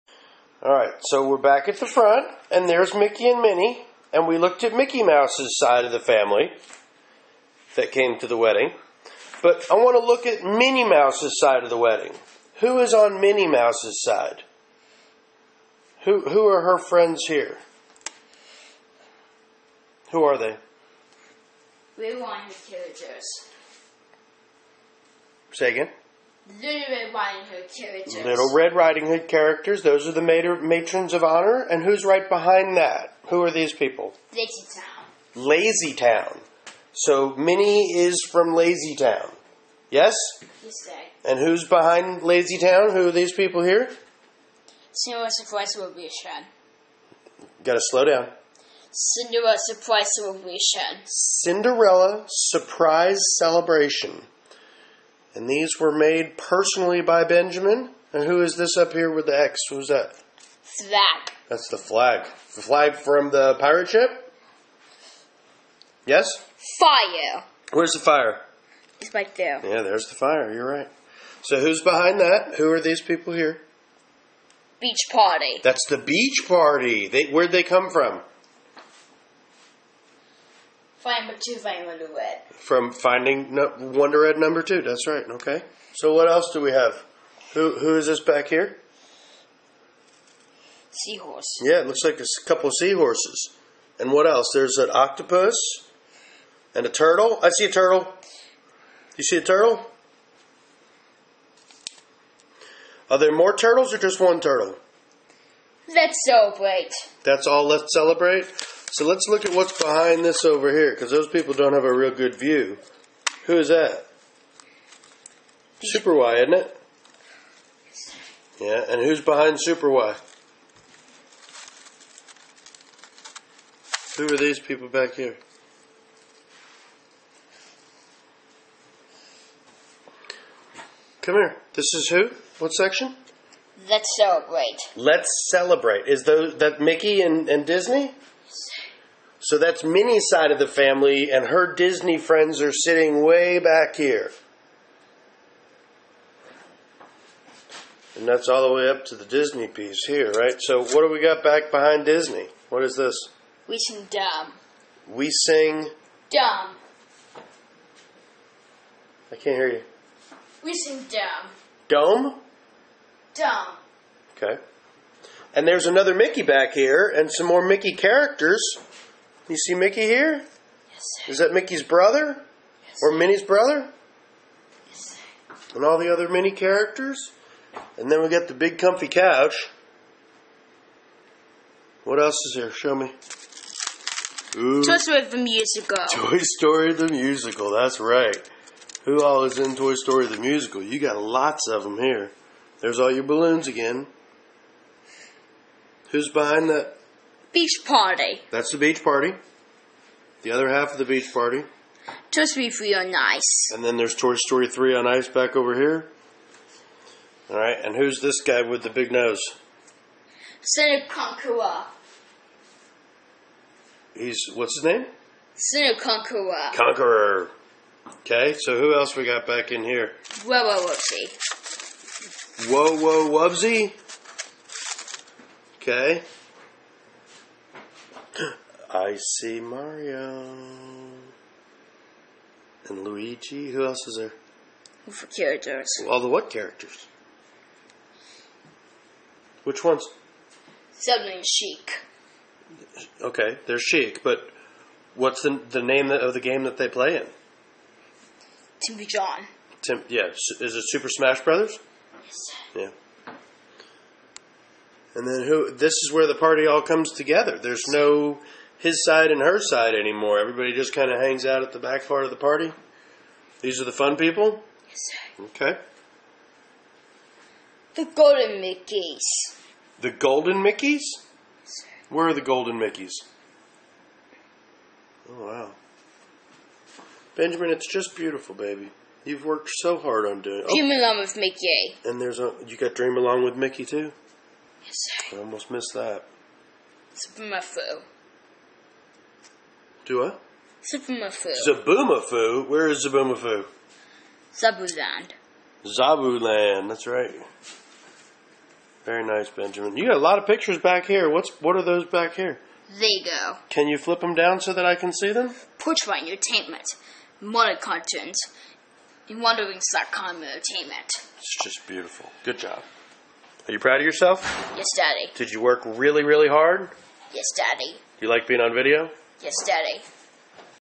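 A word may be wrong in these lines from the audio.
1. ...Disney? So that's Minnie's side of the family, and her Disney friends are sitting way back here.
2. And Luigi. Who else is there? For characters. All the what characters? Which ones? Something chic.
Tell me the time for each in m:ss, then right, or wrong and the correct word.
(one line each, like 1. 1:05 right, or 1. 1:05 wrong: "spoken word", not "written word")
1. 2:17 right
2. 3:52 right.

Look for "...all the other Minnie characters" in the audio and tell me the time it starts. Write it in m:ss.
2:55.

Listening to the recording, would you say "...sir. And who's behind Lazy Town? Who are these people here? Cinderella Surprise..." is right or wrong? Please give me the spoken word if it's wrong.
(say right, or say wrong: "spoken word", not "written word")
right.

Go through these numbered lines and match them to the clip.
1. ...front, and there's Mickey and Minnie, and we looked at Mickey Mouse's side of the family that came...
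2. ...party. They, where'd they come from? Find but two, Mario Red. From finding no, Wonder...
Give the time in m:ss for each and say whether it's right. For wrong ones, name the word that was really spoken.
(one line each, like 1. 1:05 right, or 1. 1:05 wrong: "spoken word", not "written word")
1. 0:01 right
2. 1:16 wrong: "Wonder", not "Mario".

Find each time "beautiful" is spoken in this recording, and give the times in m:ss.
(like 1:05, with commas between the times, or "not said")
4:38, 5:11.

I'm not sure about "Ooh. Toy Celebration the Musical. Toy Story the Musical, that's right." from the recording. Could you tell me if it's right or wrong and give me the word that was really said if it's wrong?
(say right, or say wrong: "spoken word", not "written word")
wrong: "Story", not "Celebration".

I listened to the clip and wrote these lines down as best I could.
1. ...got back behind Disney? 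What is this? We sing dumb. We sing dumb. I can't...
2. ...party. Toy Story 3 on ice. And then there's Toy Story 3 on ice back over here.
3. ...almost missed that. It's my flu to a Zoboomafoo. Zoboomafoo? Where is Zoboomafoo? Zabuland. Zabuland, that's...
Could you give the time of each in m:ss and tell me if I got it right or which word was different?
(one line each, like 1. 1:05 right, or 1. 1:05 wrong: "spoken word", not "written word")
1. 2:31 right
2. 3:21 right
3. 4:45 right.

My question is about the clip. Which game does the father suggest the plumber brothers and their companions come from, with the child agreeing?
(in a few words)
Super Smash Brothers.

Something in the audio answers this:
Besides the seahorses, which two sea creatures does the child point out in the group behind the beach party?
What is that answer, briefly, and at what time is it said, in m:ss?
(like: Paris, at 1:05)
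an octopus and a turtle, at 1:34.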